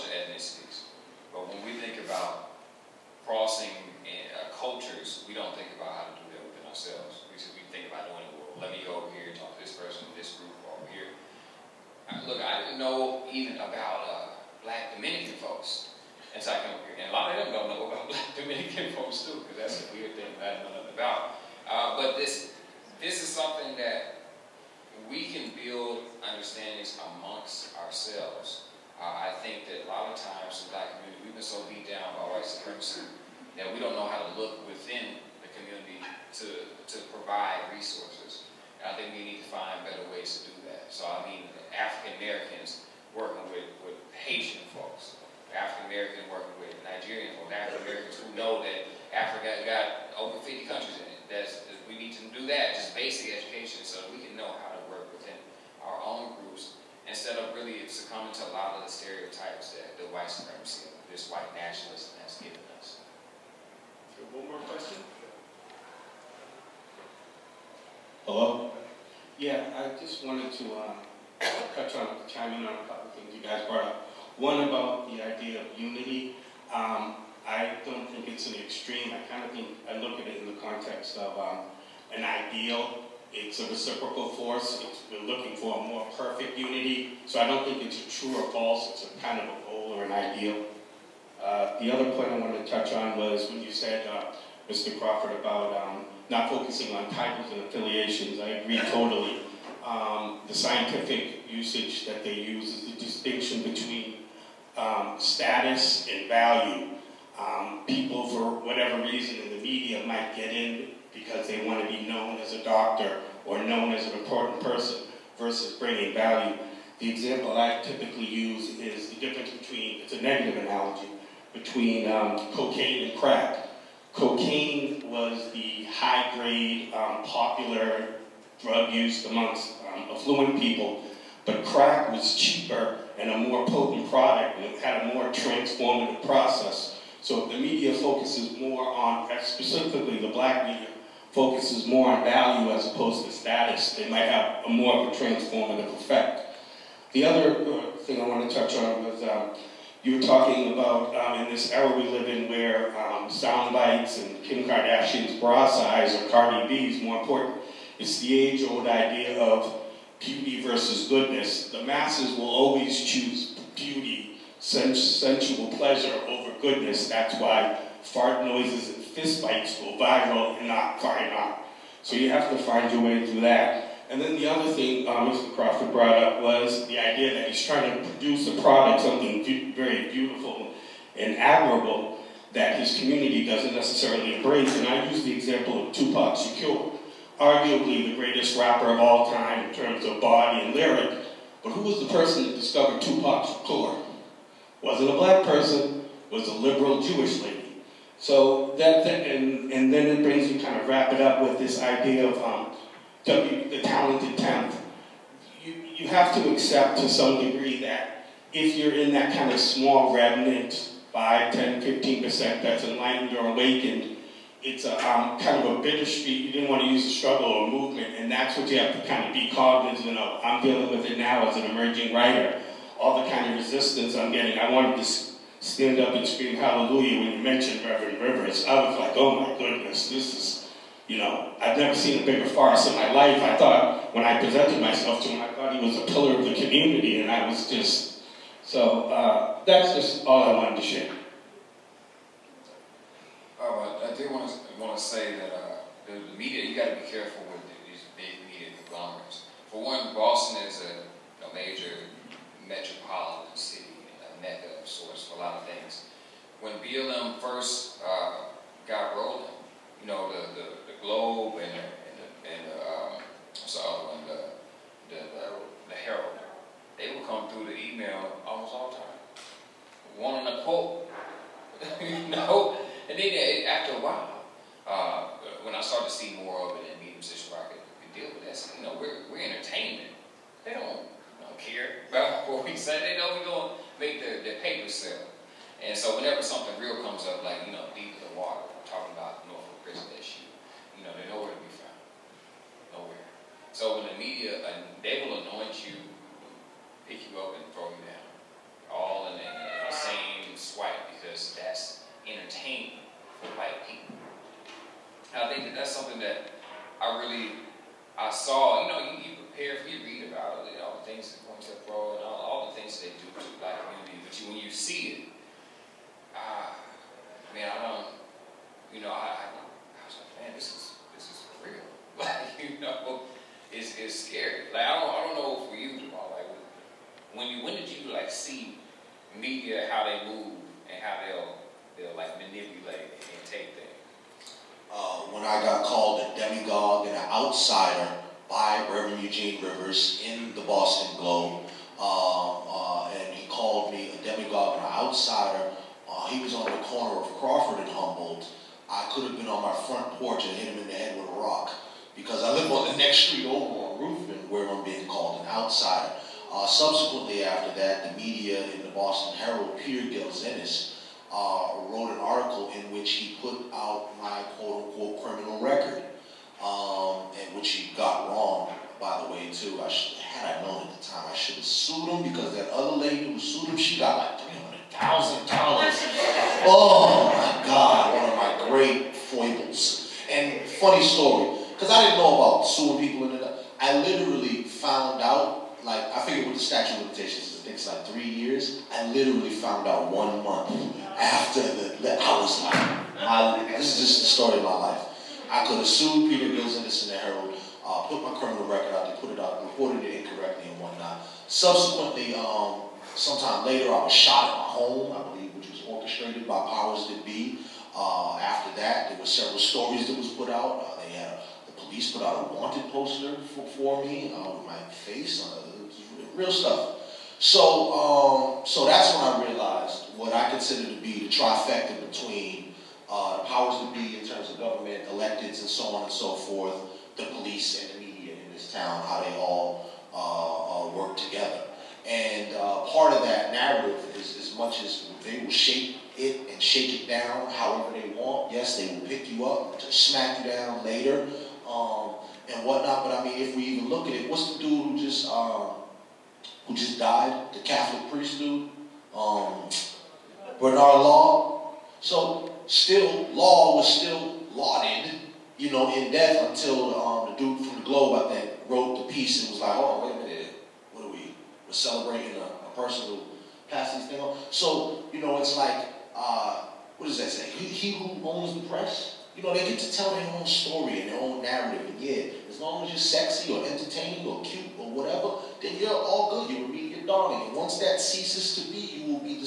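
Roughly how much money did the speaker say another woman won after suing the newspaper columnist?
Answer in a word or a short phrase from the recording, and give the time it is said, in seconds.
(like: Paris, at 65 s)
$300,000, at 374 s.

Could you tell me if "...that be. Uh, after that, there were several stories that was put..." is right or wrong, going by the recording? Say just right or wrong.
right.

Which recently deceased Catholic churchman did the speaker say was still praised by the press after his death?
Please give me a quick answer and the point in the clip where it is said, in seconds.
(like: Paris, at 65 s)
Bernard Law, at 450 s.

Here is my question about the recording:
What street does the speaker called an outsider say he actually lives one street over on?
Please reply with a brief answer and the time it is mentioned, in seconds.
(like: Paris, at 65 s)
Ruthven, at 354 s.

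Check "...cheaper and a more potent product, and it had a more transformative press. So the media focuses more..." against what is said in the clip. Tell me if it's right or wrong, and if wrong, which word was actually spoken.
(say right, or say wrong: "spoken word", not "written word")
wrong: "process", not "press".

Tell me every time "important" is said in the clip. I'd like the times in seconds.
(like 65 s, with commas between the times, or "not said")
114 s, 157 s.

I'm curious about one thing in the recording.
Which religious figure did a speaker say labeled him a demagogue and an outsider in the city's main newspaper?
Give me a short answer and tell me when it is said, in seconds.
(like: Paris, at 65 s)
Reverend Eugene Rivers, at 338 s.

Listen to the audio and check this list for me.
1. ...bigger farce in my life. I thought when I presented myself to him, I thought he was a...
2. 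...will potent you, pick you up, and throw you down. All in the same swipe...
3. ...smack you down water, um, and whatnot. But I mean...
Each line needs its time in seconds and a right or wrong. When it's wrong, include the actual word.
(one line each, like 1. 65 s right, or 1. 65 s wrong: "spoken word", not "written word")
1. 232 s right
2. 295 s wrong: "anoint", not "potent"
3. 439 s wrong: "later", not "water".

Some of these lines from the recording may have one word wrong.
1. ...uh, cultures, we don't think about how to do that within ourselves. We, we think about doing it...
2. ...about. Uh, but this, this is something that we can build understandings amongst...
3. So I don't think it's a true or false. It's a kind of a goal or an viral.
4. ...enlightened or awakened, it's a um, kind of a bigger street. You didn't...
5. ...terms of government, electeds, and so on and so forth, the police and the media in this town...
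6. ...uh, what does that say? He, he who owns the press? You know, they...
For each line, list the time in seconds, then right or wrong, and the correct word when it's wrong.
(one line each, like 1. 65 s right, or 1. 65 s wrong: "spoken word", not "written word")
1. 4 s right
2. 20 s right
3. 87 s wrong: "ideal", not "viral"
4. 212 s right
5. 424 s right
6. 466 s right.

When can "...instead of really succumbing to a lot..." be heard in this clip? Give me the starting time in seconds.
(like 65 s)
57 s.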